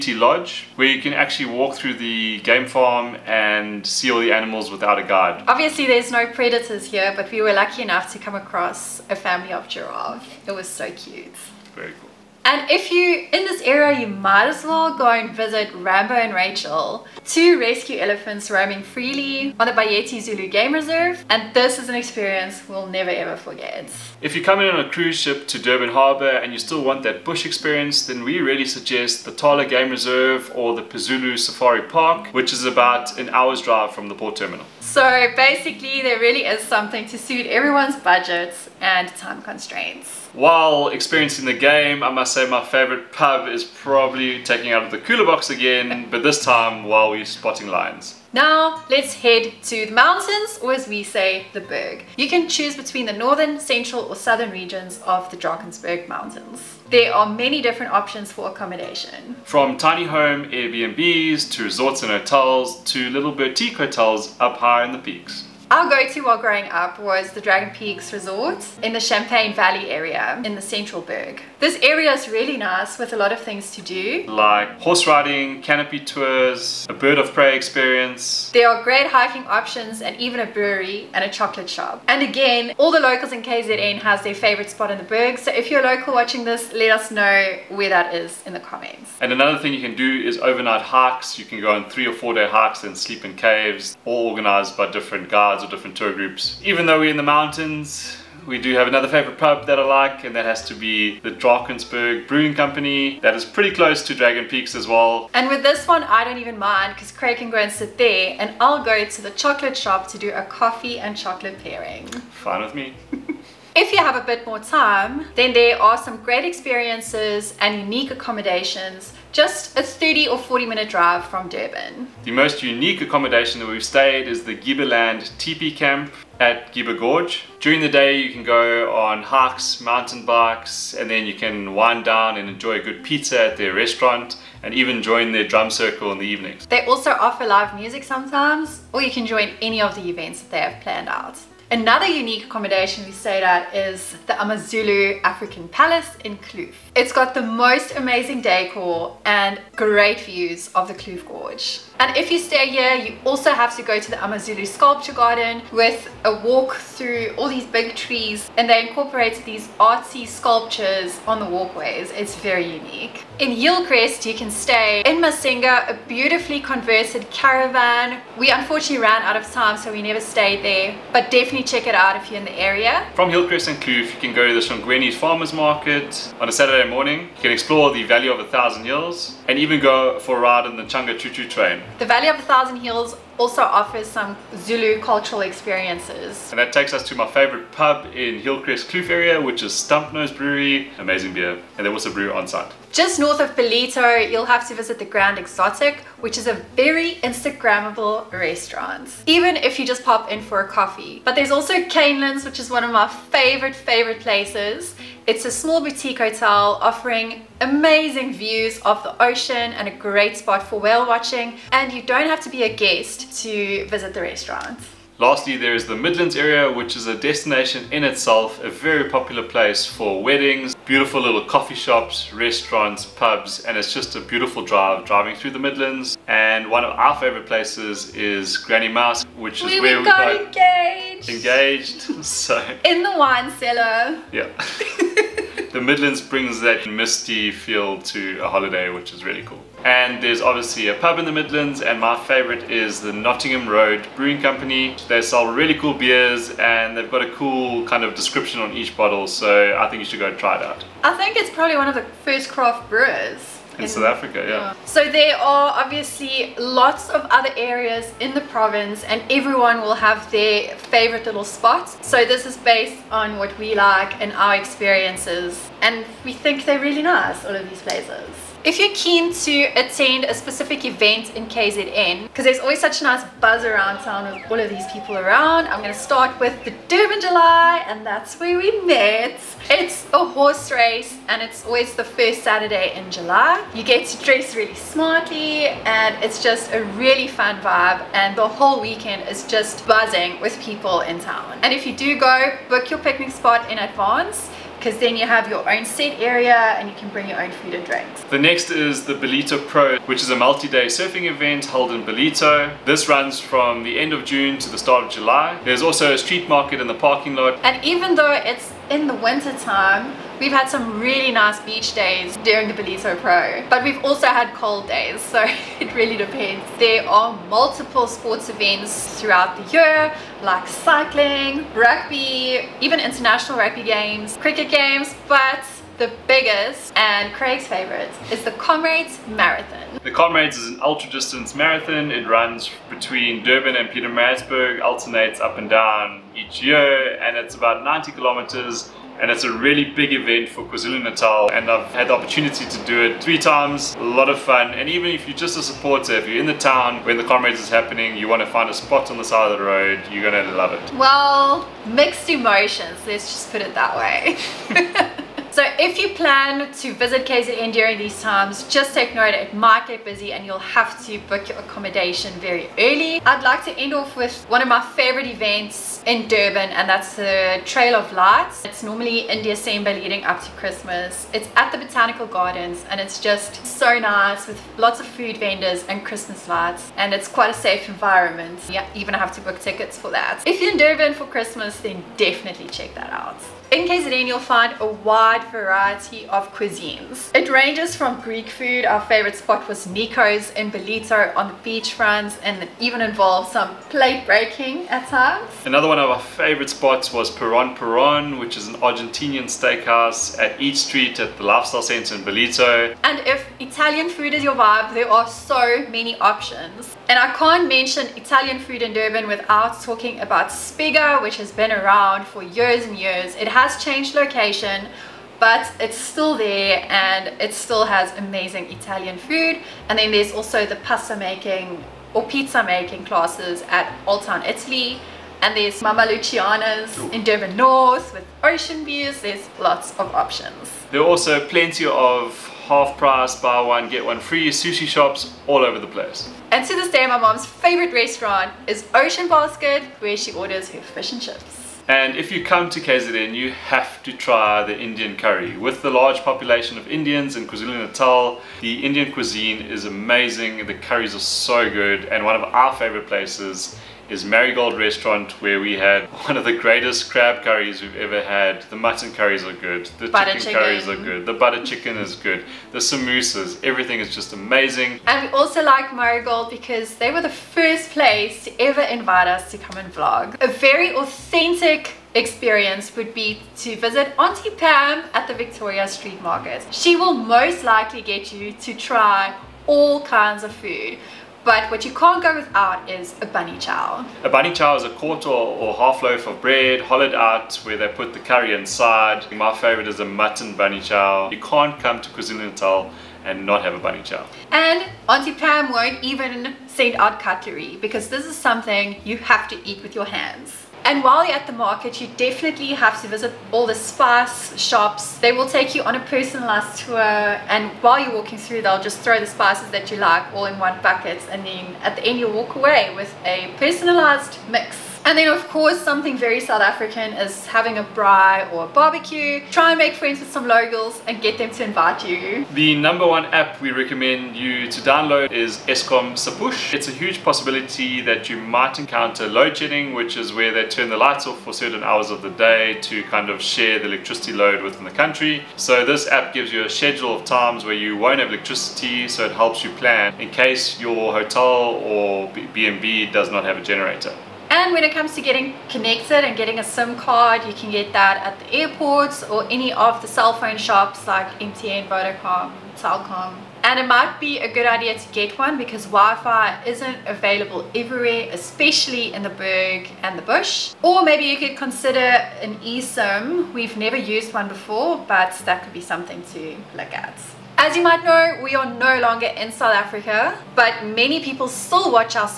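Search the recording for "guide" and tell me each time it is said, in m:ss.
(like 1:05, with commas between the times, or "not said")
0:05, 1:35.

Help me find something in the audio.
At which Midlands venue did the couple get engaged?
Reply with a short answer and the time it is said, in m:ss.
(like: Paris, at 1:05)
Granny Mouse, at 3:48.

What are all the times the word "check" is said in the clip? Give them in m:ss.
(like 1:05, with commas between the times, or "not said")
2:51, 6:22.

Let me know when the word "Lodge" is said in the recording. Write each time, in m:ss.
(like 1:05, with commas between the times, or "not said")
0:00.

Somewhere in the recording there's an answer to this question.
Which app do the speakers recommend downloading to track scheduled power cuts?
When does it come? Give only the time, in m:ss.
8:45.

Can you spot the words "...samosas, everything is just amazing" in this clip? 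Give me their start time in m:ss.
7:42.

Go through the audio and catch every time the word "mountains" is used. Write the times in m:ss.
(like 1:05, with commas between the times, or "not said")
0:49, 0:56, 1:37, 2:09.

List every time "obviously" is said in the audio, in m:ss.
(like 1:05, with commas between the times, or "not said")
0:05, 4:00, 4:15.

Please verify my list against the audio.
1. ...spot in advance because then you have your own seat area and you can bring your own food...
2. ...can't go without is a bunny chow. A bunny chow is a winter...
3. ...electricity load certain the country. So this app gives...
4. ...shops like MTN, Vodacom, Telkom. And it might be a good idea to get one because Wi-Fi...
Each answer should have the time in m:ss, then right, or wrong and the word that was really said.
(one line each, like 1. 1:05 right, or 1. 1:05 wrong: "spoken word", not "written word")
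1. 4:53 right
2. 8:01 wrong: "quarter", not "winter"
3. 8:53 wrong: "within", not "certain"
4. 9:10 right.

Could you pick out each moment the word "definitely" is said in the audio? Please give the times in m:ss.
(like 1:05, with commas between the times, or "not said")
2:51, 6:22, 8:22.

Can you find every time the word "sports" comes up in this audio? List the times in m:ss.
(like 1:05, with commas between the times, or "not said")
5:18.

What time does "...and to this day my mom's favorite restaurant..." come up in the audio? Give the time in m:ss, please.
7:16.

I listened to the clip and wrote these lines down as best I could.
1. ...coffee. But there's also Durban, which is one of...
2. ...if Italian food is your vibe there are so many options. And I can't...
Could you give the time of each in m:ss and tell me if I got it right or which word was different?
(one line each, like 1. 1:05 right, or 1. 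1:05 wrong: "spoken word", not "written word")
1. 3:20 wrong: "Canelands", not "Durban"
2. 6:43 right.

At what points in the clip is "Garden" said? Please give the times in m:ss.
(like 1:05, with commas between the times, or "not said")
2:35, 6:12.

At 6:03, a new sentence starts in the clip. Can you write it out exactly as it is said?
I'd like to end off with one of my favorite events in Durban and that's the Trail of Lights.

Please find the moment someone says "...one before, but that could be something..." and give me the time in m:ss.
9:24.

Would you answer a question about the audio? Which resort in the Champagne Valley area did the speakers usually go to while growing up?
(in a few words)
Dragon Peaks Resort.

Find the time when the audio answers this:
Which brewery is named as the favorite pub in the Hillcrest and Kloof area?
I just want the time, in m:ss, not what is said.
3:09.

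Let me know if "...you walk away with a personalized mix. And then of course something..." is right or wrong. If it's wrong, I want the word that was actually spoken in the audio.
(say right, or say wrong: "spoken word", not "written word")
right.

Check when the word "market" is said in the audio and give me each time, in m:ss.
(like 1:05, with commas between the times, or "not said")
2:55, 5:06, 7:56, 8:21.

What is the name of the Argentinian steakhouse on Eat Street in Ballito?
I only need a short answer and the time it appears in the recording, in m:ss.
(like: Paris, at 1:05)
Peron Peron, at 6:37.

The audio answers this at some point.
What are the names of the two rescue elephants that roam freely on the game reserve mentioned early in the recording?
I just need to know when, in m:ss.
0:15.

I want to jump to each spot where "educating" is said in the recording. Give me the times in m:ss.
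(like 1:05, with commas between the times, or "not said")
not said.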